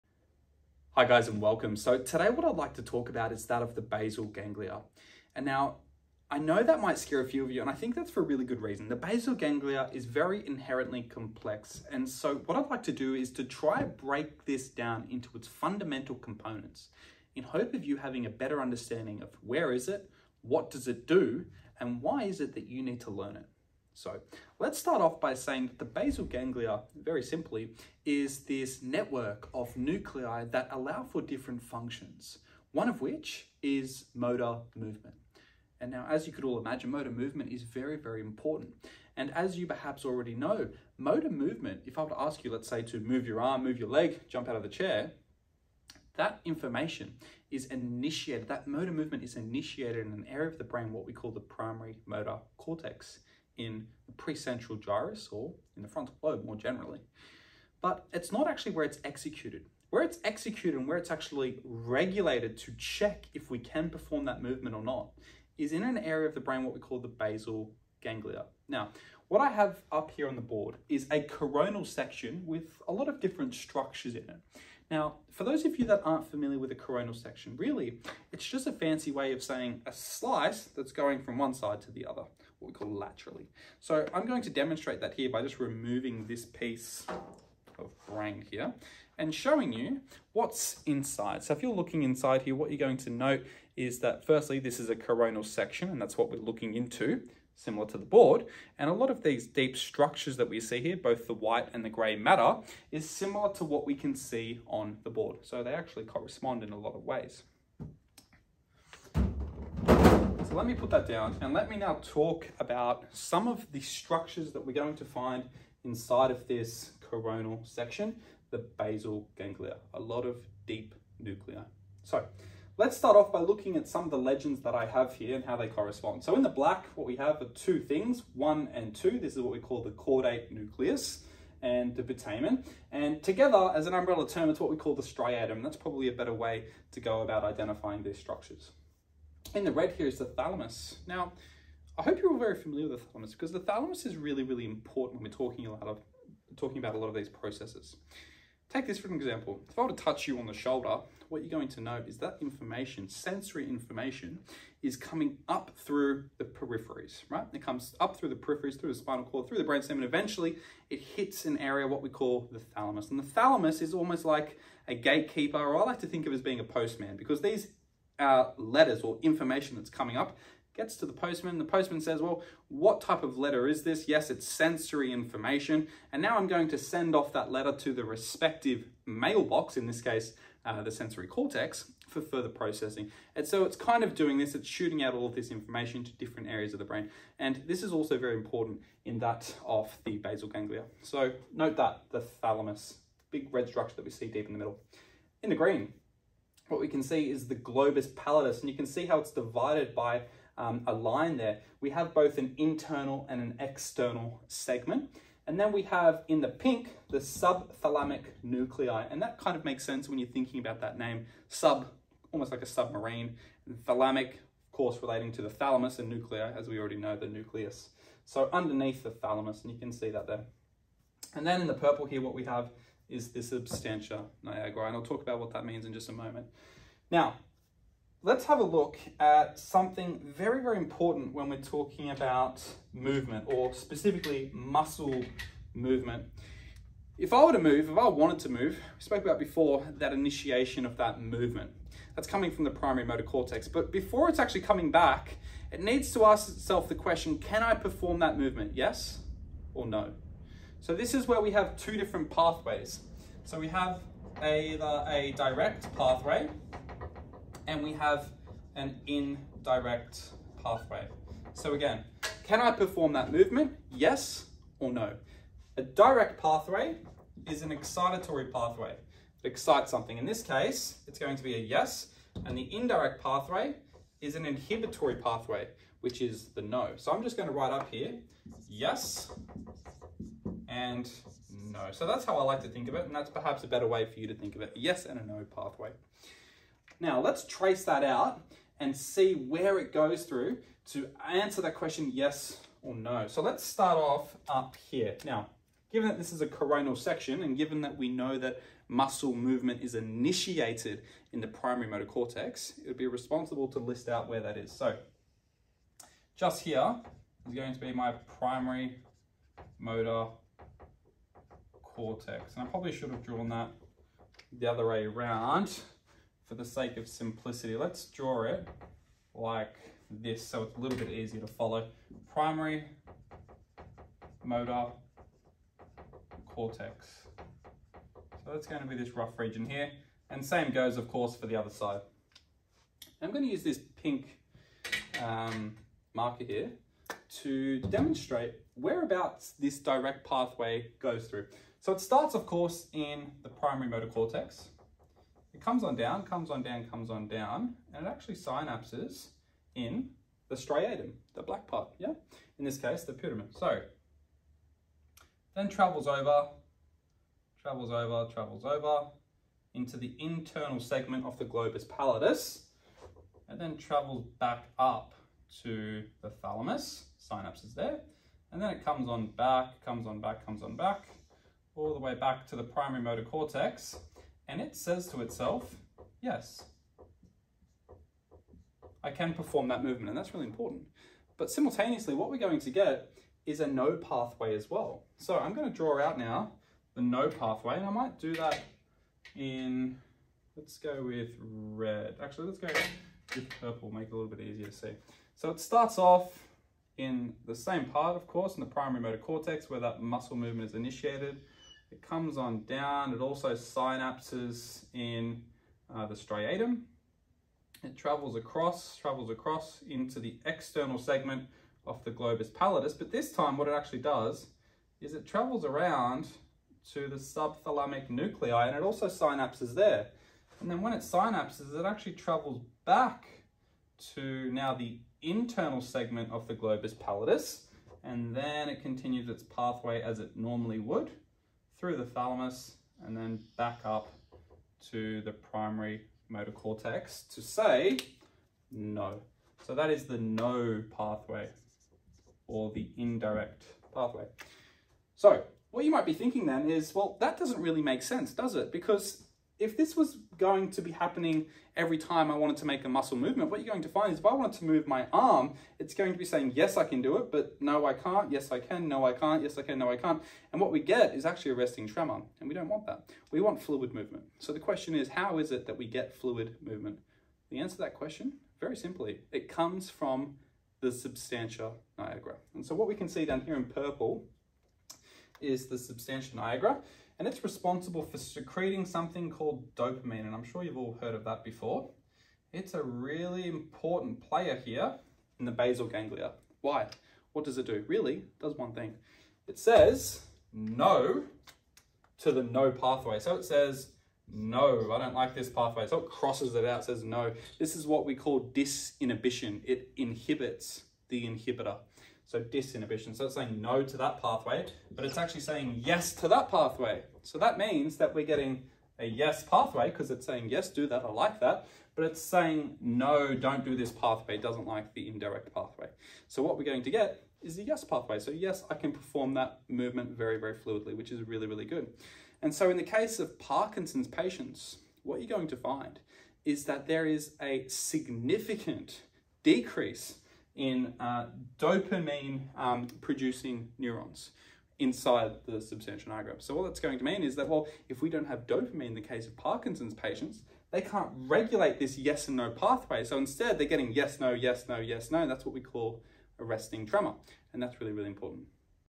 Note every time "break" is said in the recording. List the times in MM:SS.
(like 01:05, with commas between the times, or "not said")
00:13.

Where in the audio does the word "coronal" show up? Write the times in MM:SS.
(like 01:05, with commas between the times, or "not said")
01:11, 01:16, 01:34, 01:57, 04:56.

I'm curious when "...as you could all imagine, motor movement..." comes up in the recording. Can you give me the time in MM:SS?
00:36.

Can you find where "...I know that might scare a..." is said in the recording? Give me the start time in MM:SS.
00:06.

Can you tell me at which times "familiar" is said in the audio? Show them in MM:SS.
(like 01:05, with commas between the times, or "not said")
01:16, 02:22.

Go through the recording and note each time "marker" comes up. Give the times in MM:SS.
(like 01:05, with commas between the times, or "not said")
05:36.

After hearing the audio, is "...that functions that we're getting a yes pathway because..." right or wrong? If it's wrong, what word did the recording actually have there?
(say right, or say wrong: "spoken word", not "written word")
wrong: "means", not "functions".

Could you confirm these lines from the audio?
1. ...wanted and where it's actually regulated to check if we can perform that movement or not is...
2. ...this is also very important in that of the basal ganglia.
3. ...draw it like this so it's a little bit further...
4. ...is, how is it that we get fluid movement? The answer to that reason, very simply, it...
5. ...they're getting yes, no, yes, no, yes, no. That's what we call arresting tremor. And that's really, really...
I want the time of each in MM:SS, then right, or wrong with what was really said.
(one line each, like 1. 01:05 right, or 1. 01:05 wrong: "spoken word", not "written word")
1. 01:00 wrong: "executed", not "wanted"
2. 03:07 right
3. 05:18 wrong: "easier", not "further"
4. 07:44 wrong: "question", not "reason"
5. 09:03 right.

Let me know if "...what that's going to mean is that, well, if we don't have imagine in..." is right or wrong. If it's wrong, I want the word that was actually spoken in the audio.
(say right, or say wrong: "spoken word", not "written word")
wrong: "dopamine", not "imagine".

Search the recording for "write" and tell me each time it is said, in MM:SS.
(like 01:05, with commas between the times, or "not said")
04:37.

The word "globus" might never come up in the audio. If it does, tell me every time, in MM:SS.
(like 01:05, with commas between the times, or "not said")
03:17, 06:01, 06:52, 07:06.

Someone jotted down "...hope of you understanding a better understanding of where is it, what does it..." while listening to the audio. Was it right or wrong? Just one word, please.
wrong.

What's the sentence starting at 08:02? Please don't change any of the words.
It's a really important player here in the basal ganglia.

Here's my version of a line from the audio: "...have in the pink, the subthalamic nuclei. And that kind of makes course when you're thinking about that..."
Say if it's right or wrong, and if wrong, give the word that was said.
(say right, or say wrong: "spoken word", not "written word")
wrong: "sense", not "course".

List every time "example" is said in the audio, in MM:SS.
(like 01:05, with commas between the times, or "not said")
02:29.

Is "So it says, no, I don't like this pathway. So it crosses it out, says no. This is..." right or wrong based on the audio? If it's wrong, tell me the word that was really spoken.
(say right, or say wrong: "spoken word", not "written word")
right.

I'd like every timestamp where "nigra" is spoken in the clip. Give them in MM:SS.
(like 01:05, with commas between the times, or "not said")
03:44, 07:51, 07:56, 08:56.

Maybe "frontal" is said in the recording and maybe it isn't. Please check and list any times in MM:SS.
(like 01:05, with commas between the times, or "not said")
00:55.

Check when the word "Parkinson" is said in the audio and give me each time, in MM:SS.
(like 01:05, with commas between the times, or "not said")
08:43, 08:59.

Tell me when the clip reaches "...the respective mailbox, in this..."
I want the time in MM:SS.
02:57.